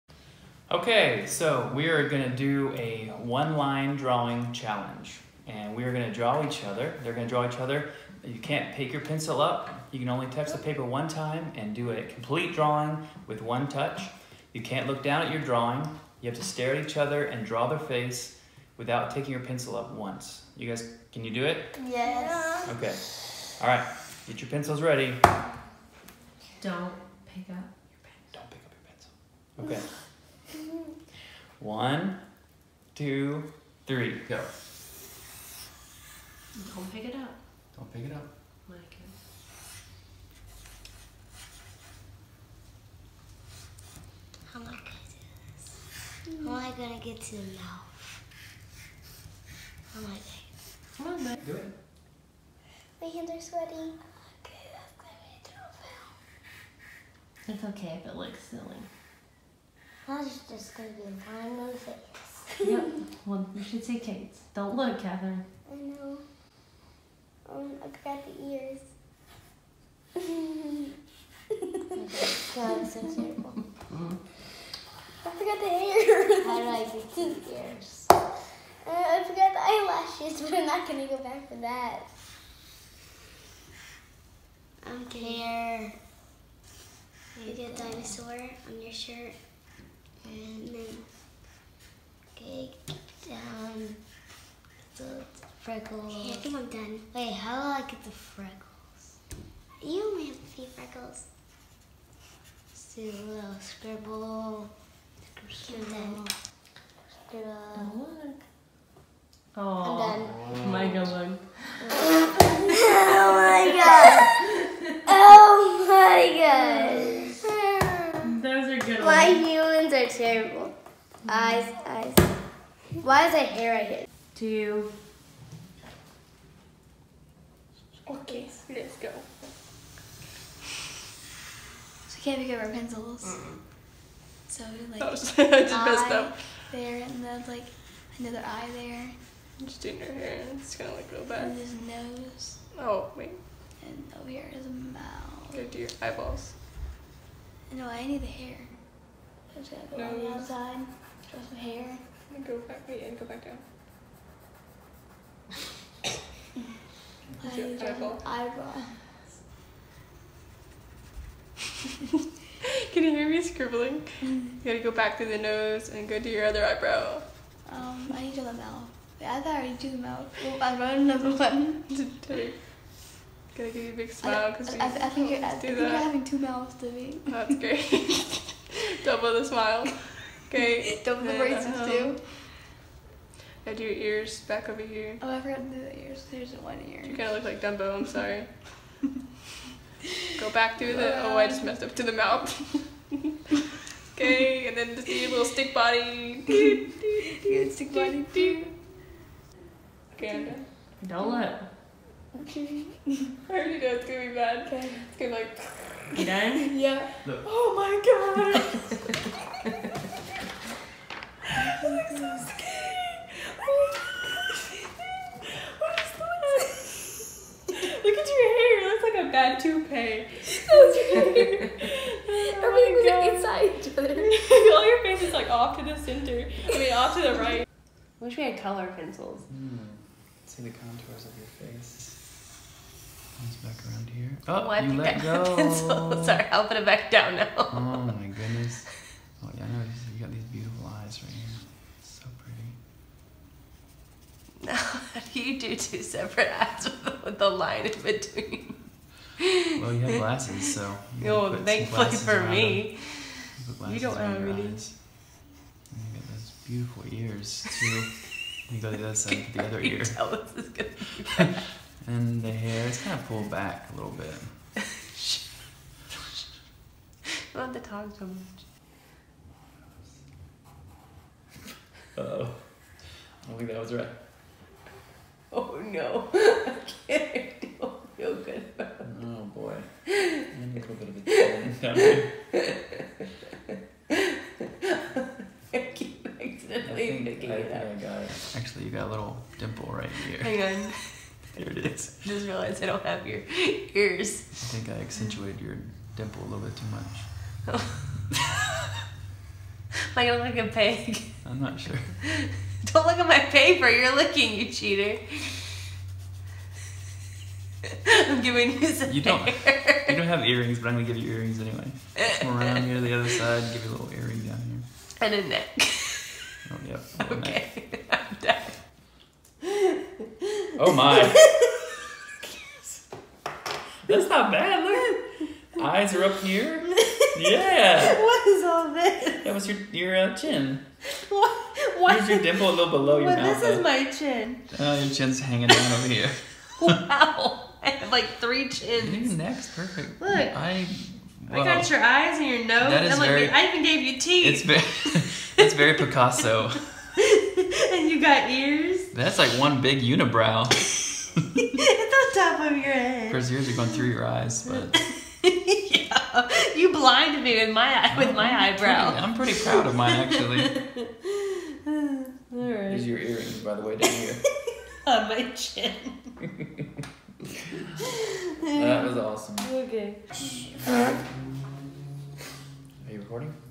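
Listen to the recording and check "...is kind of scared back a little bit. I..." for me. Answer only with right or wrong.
wrong.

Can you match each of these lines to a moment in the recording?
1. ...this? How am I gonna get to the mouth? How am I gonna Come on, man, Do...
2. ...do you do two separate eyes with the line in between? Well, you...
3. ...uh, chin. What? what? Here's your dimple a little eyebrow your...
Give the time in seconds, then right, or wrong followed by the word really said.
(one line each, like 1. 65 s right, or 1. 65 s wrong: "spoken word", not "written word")
1. 45 s right
2. 245 s right
3. 330 s wrong: "below", not "eyebrow".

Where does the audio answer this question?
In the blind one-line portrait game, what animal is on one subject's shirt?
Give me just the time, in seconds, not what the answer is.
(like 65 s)
87 s.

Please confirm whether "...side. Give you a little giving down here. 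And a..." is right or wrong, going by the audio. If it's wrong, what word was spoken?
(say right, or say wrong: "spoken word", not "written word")
wrong: "earring", not "giving".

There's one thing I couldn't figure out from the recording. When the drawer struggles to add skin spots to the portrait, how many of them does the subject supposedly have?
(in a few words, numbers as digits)
3.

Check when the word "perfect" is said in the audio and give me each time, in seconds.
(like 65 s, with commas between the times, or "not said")
339 s.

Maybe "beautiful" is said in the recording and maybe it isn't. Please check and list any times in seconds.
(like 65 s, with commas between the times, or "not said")
240 s, 256 s.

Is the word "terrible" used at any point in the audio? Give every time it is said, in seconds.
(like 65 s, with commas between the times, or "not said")
73 s, 120 s.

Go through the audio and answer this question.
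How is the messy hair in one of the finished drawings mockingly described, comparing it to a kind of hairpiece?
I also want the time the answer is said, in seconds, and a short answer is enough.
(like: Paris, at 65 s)
A bad toupee, at 219 s.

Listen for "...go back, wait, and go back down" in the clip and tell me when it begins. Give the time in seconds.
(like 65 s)
152 s.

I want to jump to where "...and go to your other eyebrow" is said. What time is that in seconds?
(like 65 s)
165 s.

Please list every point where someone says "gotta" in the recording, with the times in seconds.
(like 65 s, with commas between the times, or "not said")
164 s, 171 s.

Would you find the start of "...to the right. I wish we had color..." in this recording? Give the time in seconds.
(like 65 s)
227 s.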